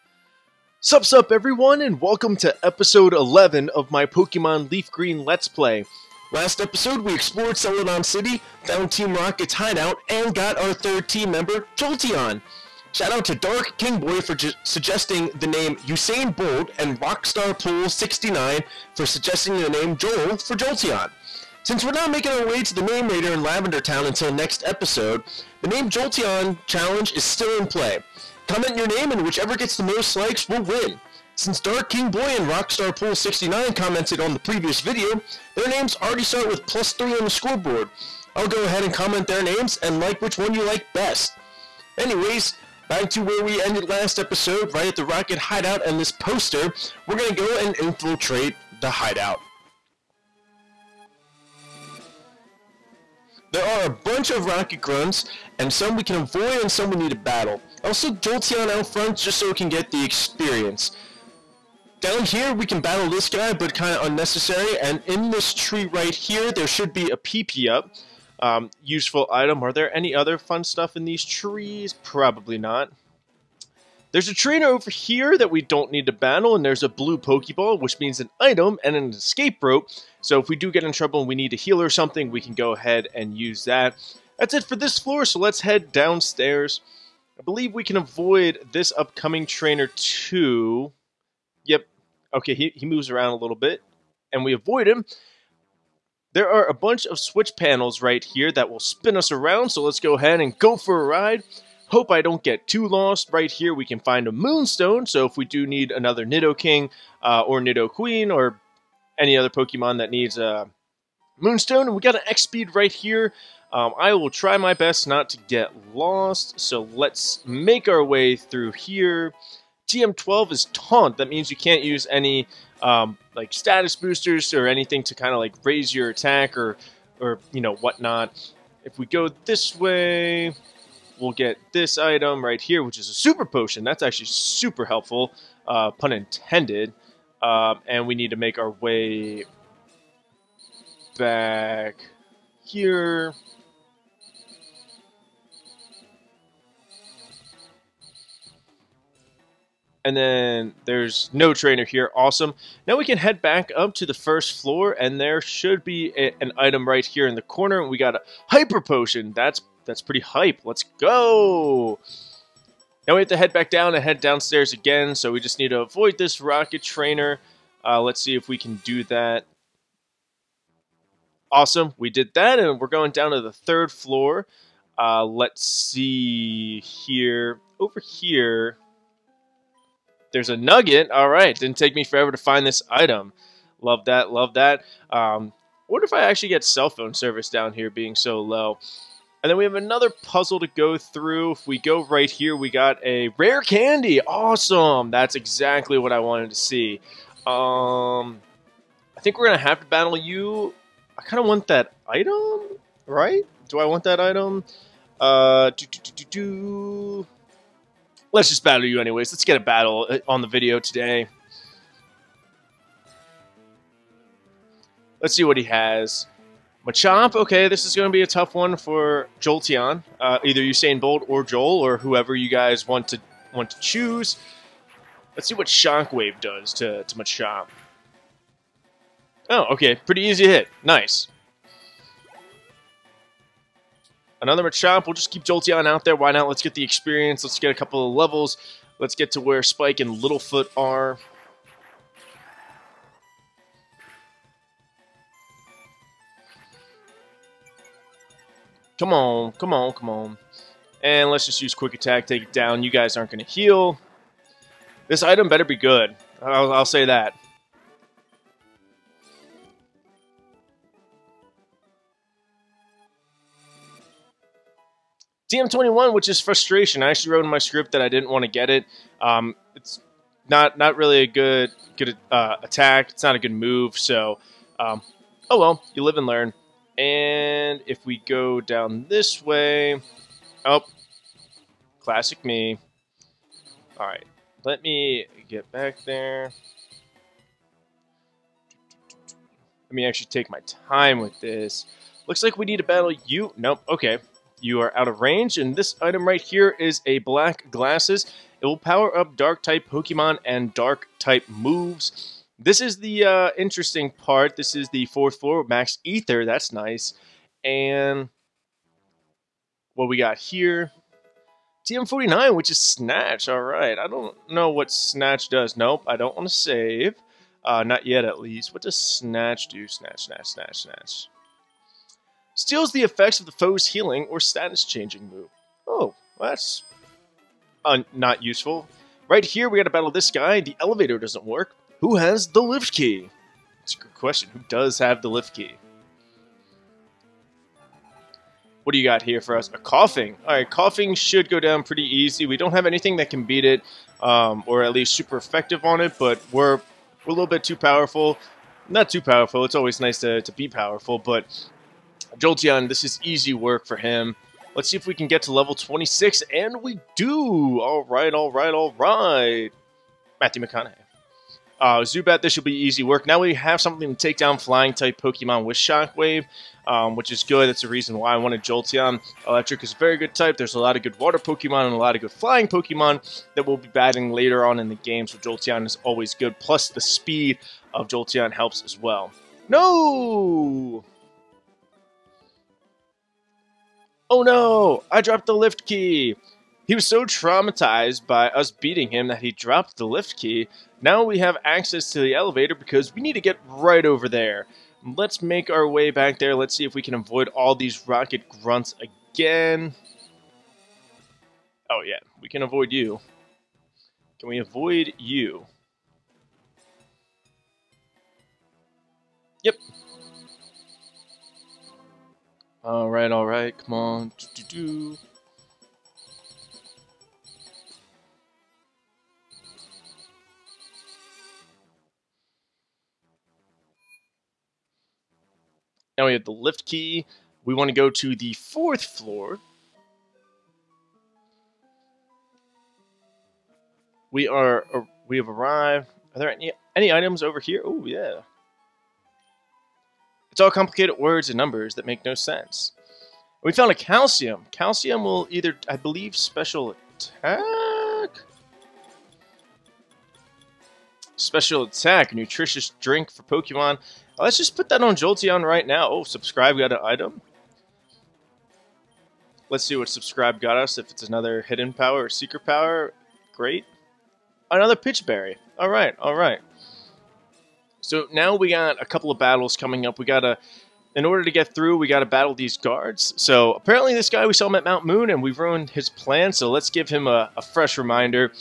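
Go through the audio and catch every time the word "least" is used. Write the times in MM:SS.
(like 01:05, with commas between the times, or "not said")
05:18, 05:44.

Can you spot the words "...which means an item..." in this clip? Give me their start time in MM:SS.
01:17.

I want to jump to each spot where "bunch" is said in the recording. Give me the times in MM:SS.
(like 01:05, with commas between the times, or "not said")
00:53, 01:36.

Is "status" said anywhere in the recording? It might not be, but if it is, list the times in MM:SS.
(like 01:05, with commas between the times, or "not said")
02:03, 05:24.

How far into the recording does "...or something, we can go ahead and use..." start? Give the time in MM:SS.
01:21.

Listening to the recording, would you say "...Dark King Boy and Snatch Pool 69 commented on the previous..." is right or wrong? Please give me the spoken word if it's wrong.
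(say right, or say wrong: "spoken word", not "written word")
wrong: "Rockstar", not "Snatch".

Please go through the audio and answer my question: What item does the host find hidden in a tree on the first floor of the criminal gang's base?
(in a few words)
PP Up.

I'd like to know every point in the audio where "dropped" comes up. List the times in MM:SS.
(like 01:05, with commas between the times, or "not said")
06:25, 06:29.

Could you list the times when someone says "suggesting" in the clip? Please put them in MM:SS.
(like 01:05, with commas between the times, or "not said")
00:14, 00:19.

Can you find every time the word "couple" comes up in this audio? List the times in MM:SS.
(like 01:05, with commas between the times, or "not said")
03:57, 07:49.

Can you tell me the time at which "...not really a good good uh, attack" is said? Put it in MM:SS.
04:30.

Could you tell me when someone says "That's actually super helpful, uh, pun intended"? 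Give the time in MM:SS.
02:13.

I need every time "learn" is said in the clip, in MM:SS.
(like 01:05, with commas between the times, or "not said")
04:36.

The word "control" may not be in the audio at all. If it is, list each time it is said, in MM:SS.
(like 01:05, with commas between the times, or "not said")
not said.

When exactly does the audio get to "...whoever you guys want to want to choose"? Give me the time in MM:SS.
03:41.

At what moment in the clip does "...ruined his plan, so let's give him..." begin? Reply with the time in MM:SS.
07:55.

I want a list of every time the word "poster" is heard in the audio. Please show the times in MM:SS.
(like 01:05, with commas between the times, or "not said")
00:46.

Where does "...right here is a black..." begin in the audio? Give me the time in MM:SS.
04:56.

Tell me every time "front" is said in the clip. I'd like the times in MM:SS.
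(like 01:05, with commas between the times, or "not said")
00:58.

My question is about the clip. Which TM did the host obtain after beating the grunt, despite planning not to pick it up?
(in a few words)
TM 21.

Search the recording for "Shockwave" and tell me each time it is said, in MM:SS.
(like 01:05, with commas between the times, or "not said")
03:45, 06:05.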